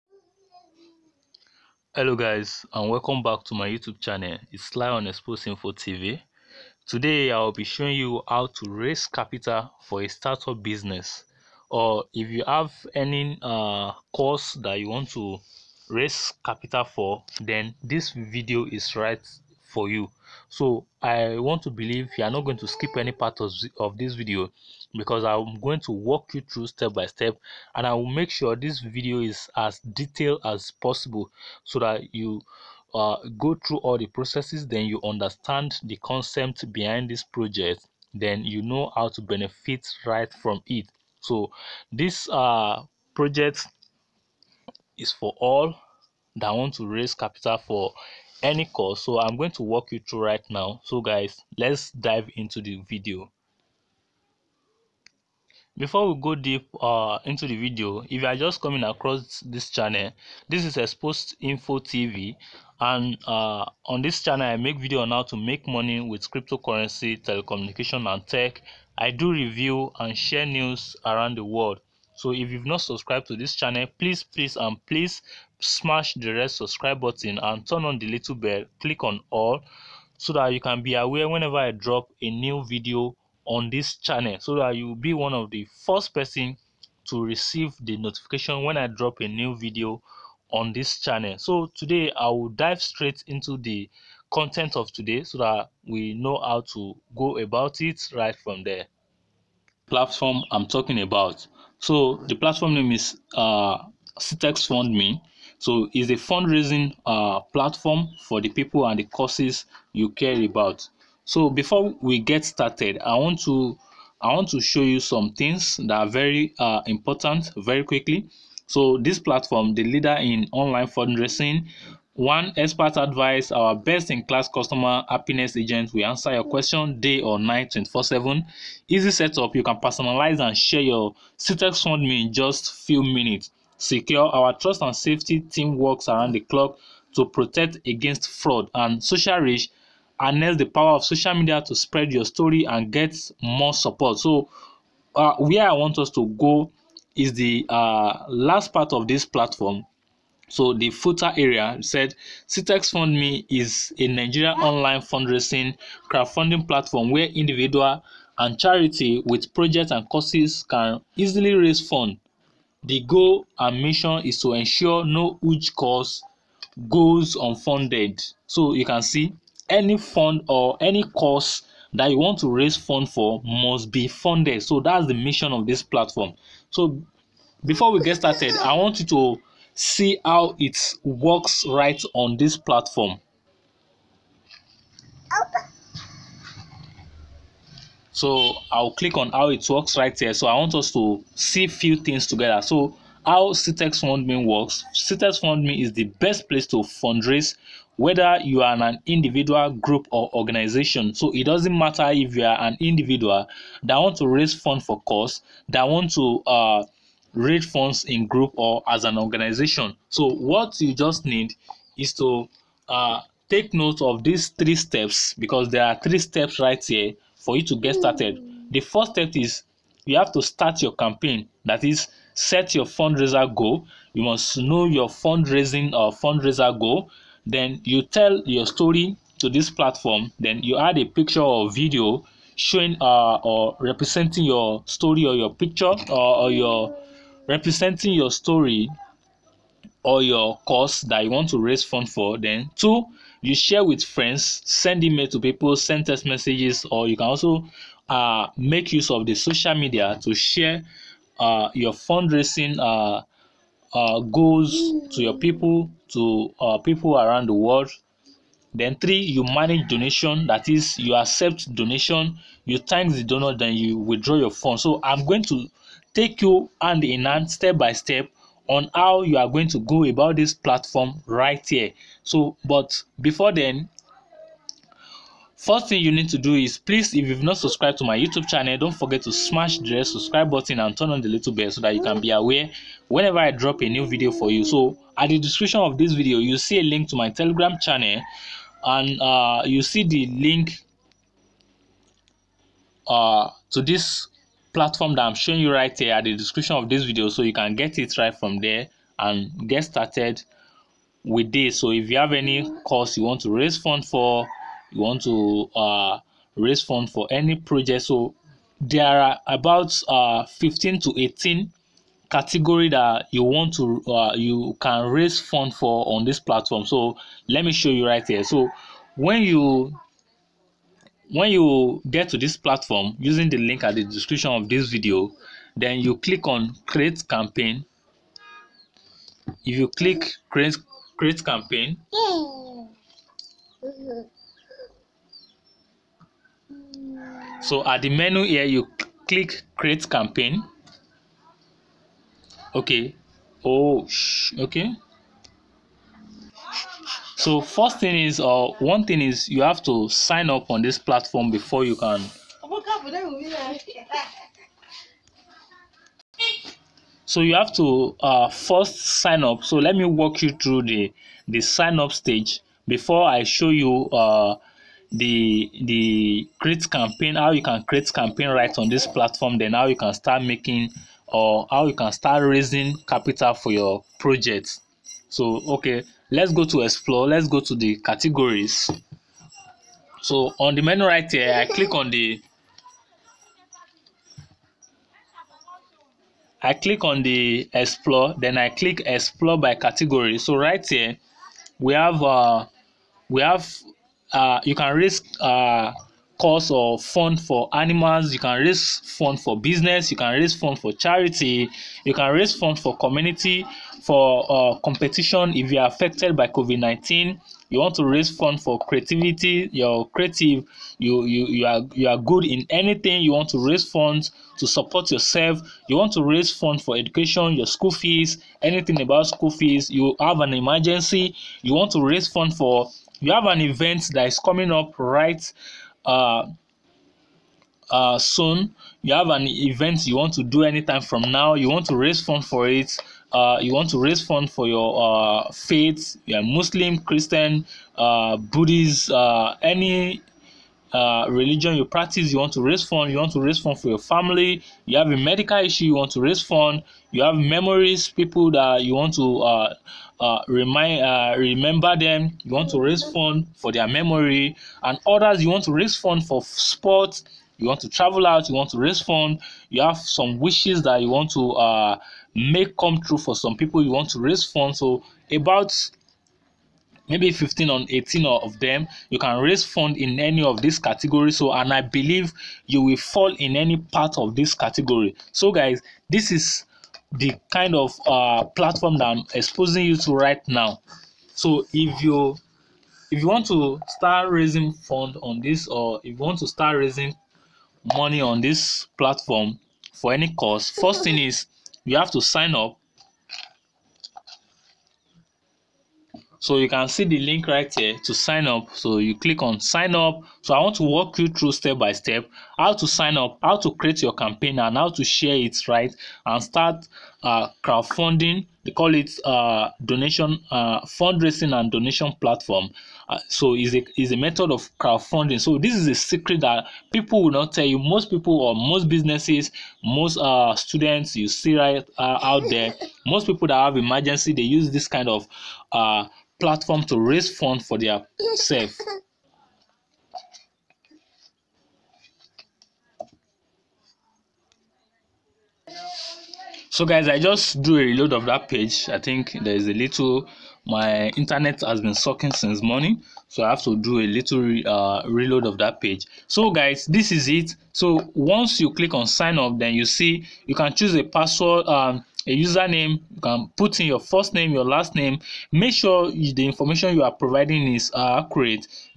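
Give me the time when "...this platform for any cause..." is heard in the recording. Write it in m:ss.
8:08.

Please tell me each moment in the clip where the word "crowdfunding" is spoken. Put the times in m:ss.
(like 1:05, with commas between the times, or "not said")
2:36, 8:27, 8:34.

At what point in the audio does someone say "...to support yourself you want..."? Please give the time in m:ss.
6:54.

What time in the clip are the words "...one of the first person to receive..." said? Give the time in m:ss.
1:25.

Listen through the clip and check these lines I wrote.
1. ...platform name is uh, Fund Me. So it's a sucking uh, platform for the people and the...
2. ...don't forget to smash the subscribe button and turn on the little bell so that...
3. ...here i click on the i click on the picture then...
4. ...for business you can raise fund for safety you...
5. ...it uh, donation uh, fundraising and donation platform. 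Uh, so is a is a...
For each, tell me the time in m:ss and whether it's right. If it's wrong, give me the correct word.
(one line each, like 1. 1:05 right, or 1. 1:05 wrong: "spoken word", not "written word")
1. 1:42 wrong: "fundraising", not "sucking"
2. 4:38 right
3. 6:21 wrong: "explore", not "picture"
4. 6:39 wrong: "charity", not "safety"
5. 8:28 right.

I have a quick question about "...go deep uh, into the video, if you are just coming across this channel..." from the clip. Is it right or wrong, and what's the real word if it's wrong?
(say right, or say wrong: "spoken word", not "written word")
right.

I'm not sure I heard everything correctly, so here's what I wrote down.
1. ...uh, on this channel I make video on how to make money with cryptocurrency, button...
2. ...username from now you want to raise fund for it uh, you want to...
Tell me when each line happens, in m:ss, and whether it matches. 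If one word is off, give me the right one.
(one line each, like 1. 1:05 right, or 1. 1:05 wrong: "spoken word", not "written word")
1. 1:03 wrong: "telecommunication", not "button"
2. 7:10 wrong: "anytime", not "username".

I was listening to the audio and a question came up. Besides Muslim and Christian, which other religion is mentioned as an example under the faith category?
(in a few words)
Buddhist.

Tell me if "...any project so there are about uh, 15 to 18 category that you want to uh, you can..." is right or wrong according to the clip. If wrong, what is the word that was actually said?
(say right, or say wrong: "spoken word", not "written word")
right.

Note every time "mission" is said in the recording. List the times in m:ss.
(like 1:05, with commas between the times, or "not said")
2:43, 2:55.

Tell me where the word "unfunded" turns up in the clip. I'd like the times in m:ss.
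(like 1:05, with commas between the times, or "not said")
2:47.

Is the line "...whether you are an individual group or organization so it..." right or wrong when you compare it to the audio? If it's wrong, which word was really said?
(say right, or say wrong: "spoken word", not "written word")
right.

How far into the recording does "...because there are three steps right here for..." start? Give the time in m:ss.
3:35.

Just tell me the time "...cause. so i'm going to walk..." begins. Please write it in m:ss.
0:48.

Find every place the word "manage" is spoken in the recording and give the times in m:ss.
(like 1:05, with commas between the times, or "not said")
4:19.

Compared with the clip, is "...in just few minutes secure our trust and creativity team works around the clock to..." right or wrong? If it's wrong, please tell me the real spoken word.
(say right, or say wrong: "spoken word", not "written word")
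wrong: "safety", not "creativity".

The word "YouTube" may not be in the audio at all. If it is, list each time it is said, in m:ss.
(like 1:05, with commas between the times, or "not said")
0:03, 4:38.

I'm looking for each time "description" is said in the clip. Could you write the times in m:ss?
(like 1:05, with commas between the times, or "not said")
4:45, 4:56, 5:24.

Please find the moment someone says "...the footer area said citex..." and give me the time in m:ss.
2:30.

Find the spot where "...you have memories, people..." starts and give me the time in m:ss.
7:27.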